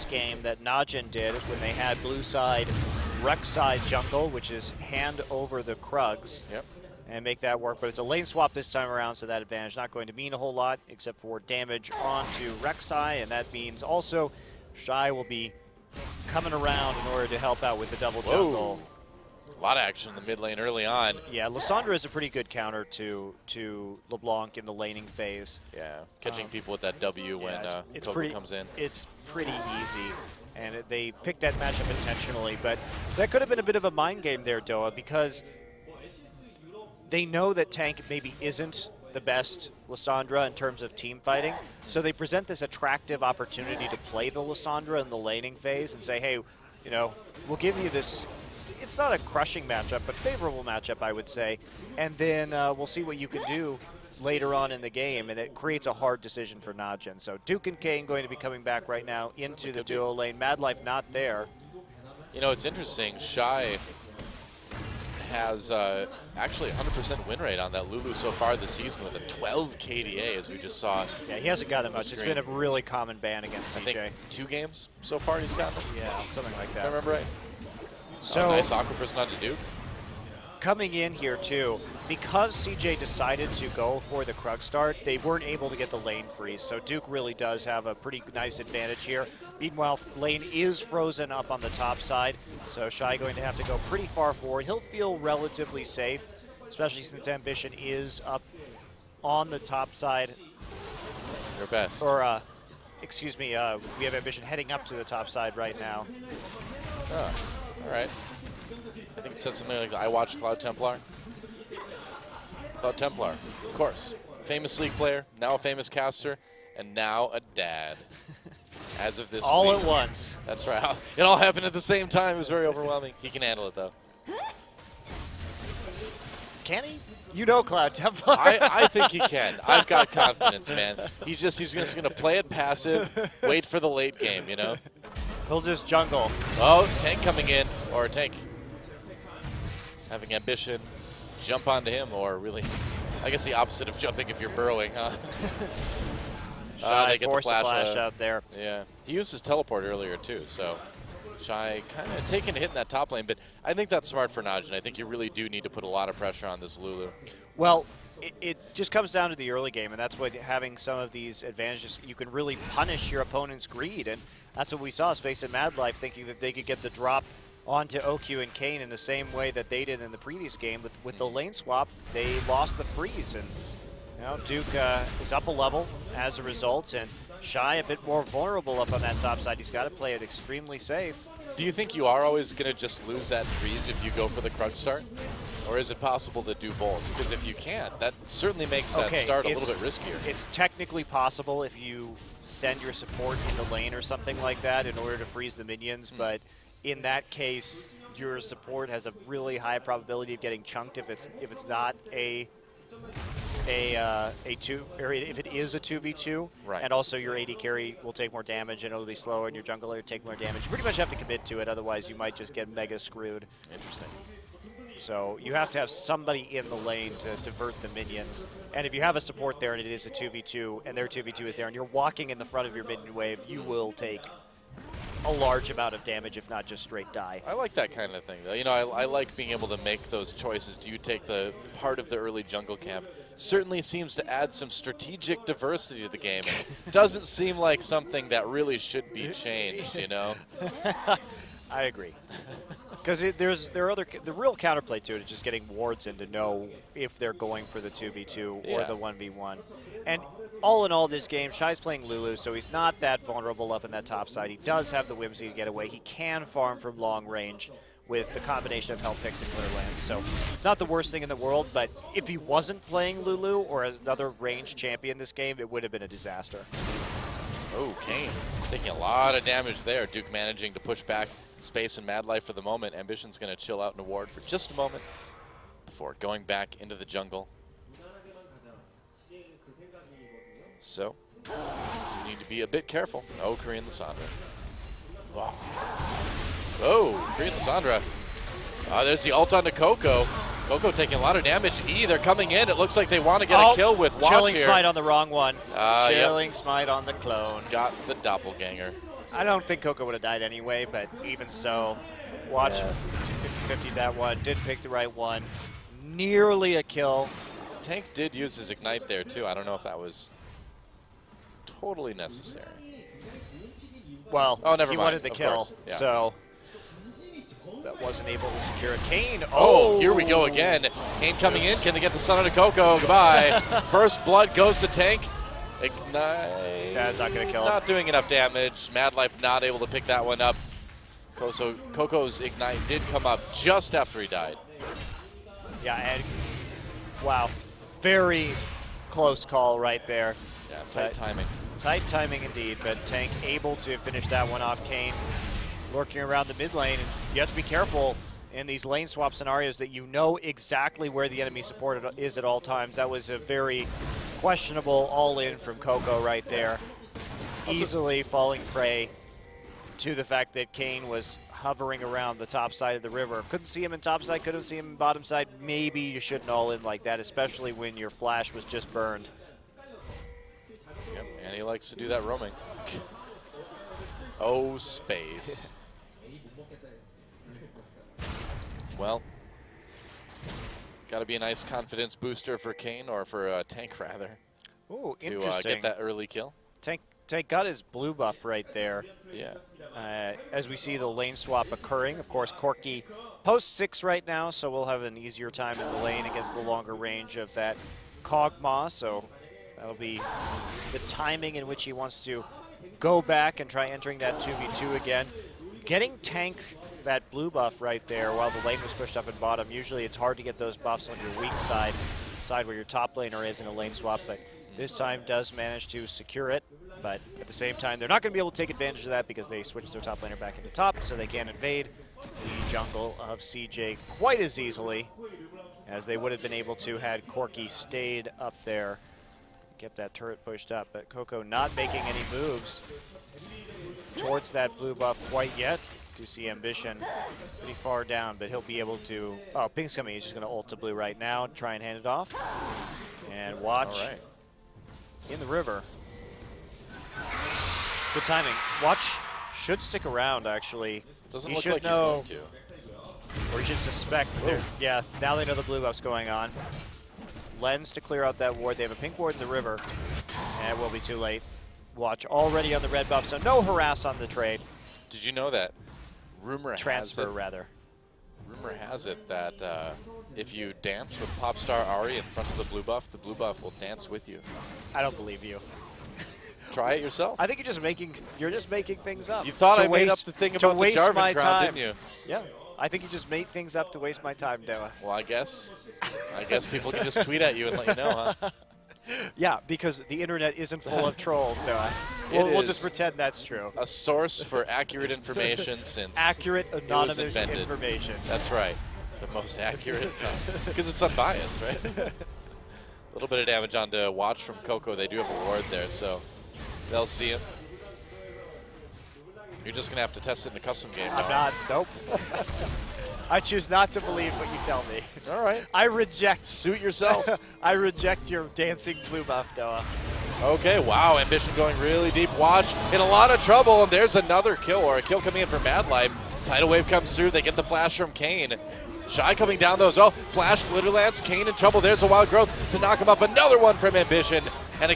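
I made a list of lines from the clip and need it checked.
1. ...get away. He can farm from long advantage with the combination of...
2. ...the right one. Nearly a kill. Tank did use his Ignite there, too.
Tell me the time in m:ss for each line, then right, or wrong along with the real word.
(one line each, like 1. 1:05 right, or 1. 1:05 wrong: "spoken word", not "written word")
1. 4:15 wrong: "range", not "advantage"
2. 5:04 right.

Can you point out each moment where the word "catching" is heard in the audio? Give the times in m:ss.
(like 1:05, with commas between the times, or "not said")
0:26.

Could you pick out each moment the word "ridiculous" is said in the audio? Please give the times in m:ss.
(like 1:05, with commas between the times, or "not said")
not said.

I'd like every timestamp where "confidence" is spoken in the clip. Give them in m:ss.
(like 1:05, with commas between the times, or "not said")
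2:10, 6:21.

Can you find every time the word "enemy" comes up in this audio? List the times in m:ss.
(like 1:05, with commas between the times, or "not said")
5:51.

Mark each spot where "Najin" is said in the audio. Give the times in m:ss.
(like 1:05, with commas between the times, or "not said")
0:00, 0:56, 2:34.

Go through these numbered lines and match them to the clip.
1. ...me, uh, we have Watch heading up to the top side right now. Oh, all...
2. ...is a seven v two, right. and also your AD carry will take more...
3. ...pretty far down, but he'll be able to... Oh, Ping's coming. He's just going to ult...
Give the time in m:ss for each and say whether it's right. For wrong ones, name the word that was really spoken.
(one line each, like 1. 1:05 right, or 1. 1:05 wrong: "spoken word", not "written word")
1. 1:43 wrong: "Ambition", not "Watch"
2. 3:25 wrong: "two", not "seven"
3. 7:17 right.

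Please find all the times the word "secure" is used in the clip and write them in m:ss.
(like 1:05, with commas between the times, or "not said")
5:18, 6:56.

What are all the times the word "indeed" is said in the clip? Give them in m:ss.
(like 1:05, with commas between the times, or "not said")
5:42.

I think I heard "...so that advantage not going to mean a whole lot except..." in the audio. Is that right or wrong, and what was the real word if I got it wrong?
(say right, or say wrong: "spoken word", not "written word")
right.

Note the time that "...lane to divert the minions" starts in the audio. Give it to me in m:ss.
3:36.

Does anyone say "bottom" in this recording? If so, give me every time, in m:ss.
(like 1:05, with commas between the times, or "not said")
6:04, 6:49.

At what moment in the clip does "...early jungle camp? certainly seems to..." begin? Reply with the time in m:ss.
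3:52.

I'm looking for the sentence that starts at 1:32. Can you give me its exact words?
So Shy going to have to go pretty far forward.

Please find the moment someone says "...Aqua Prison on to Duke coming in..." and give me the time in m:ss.
1:18.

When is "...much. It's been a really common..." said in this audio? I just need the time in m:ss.
1:11.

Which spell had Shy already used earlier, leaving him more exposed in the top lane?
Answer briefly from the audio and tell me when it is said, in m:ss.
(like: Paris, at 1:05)
Teleport, at 2:29.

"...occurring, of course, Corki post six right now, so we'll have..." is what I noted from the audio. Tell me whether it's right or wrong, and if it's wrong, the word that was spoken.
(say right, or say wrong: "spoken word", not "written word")
right.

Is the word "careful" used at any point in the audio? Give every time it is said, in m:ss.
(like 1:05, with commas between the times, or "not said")
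4:42, 5:47.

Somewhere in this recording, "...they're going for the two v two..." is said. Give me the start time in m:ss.
4:07.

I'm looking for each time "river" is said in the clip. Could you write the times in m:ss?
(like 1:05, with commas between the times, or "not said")
6:03, 7:25, 7:39.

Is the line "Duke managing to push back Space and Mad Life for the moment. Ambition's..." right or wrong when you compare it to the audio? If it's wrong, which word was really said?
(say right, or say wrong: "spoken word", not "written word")
right.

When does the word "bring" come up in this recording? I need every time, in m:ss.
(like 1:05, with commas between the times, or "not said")
not said.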